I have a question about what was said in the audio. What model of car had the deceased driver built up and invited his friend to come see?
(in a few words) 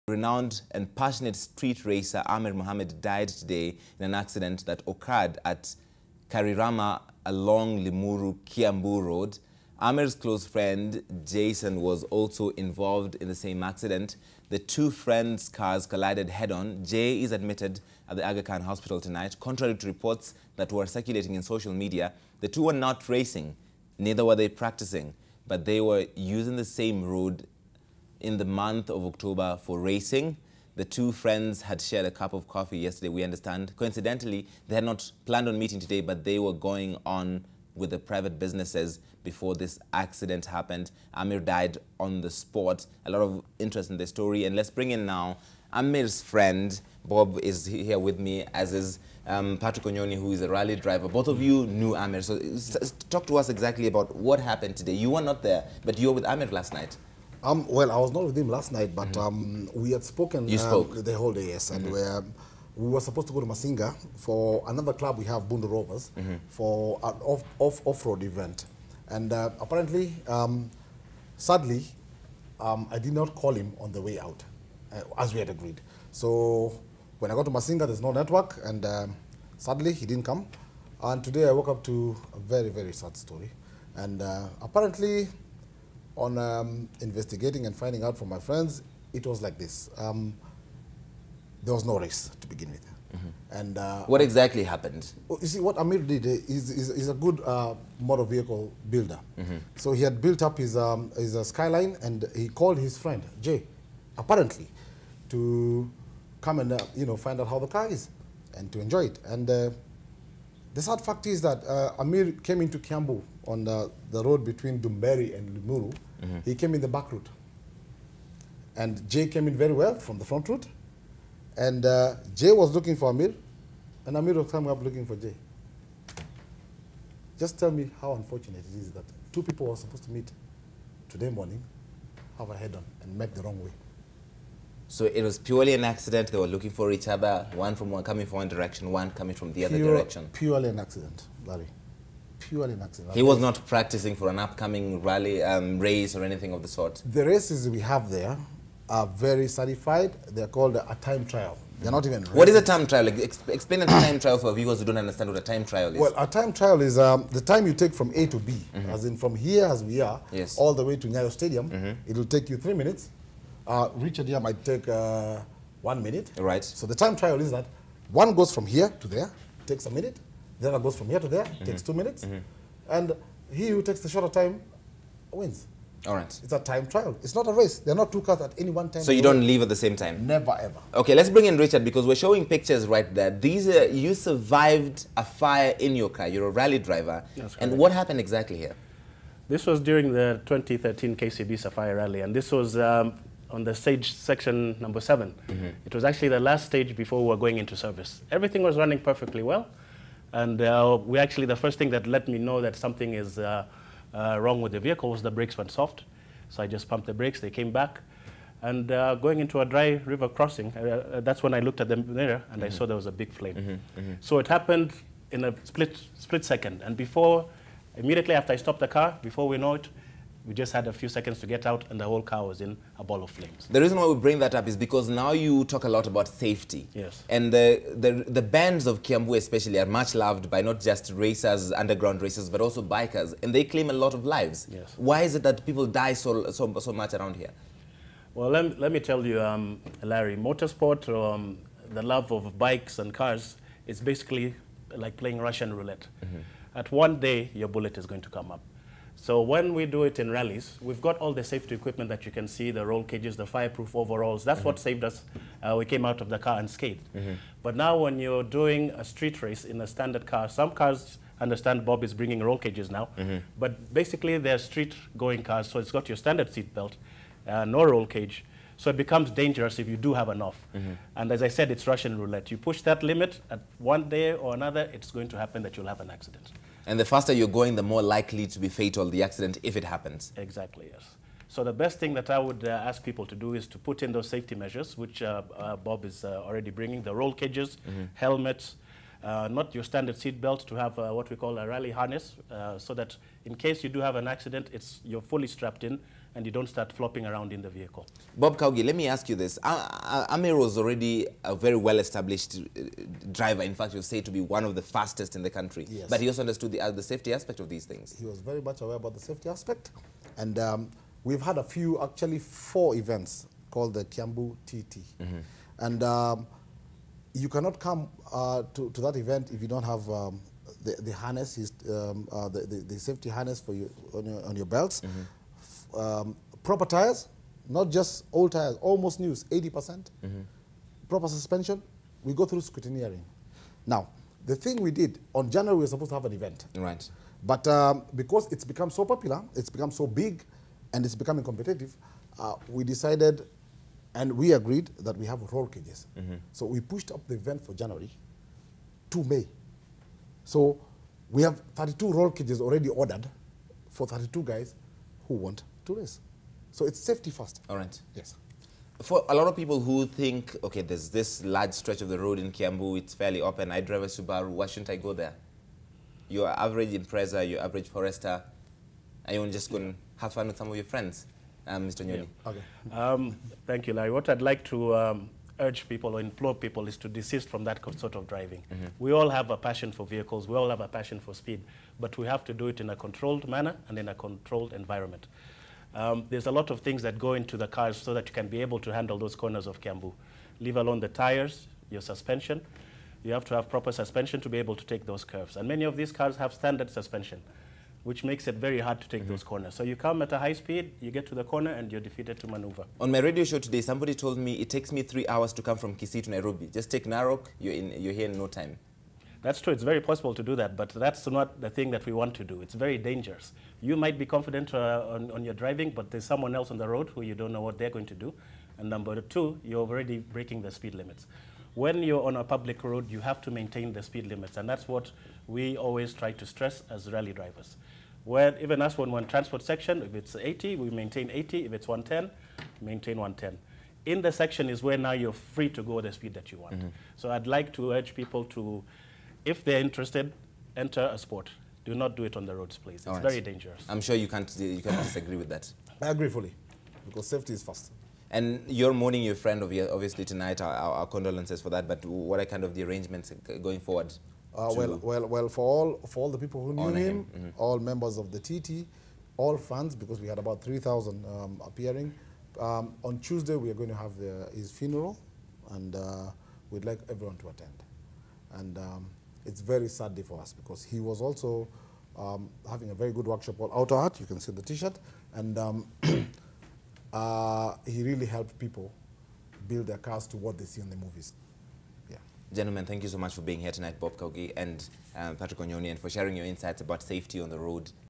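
Skyline.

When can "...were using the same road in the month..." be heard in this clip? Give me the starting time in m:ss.
0:25.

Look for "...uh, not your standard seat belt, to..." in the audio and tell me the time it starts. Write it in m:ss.
4:49.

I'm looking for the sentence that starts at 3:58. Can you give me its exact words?
Well, let, let me tell you, um, Larry, motorsport, um, the love of bikes and cars, is basically like playing Russian roulette.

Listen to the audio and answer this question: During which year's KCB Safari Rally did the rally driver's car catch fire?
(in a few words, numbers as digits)
2013.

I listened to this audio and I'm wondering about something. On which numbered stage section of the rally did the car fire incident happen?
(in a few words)
7.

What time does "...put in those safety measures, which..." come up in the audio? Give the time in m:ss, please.
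4:43.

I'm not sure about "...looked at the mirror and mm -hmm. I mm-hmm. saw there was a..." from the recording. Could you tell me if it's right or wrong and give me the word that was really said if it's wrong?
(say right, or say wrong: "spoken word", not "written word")
right.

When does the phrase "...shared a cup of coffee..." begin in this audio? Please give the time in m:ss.
0:31.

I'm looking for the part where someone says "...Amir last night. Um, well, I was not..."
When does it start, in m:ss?
0:56.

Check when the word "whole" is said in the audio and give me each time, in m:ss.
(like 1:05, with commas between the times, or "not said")
1:01, 3:42.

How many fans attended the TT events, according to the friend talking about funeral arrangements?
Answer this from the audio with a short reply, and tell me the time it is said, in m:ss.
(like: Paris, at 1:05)
3,000, at 7:40.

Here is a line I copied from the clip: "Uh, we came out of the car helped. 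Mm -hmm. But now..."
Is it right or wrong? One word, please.
wrong.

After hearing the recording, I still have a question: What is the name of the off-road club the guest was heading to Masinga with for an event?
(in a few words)
Bundu Rovers.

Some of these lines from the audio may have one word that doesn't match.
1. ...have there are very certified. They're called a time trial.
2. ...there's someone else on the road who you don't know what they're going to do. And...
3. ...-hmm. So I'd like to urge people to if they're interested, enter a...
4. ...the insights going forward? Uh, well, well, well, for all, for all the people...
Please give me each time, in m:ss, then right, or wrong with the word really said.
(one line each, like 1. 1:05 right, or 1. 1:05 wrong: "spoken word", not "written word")
1. 2:27 right
2. 6:56 right
3. 7:16 right
4. 7:32 wrong: "arrangements", not "insights".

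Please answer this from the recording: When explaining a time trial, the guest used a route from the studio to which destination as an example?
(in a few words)
Nyayo Stadium.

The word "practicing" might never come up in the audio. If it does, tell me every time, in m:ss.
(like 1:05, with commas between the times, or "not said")
0:24, 2:23.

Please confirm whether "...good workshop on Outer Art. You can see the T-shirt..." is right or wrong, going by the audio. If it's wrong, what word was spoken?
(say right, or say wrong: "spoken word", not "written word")
right.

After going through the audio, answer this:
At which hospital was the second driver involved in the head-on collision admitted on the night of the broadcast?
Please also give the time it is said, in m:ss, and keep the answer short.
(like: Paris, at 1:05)
Aga Khan Hospital, at 0:18.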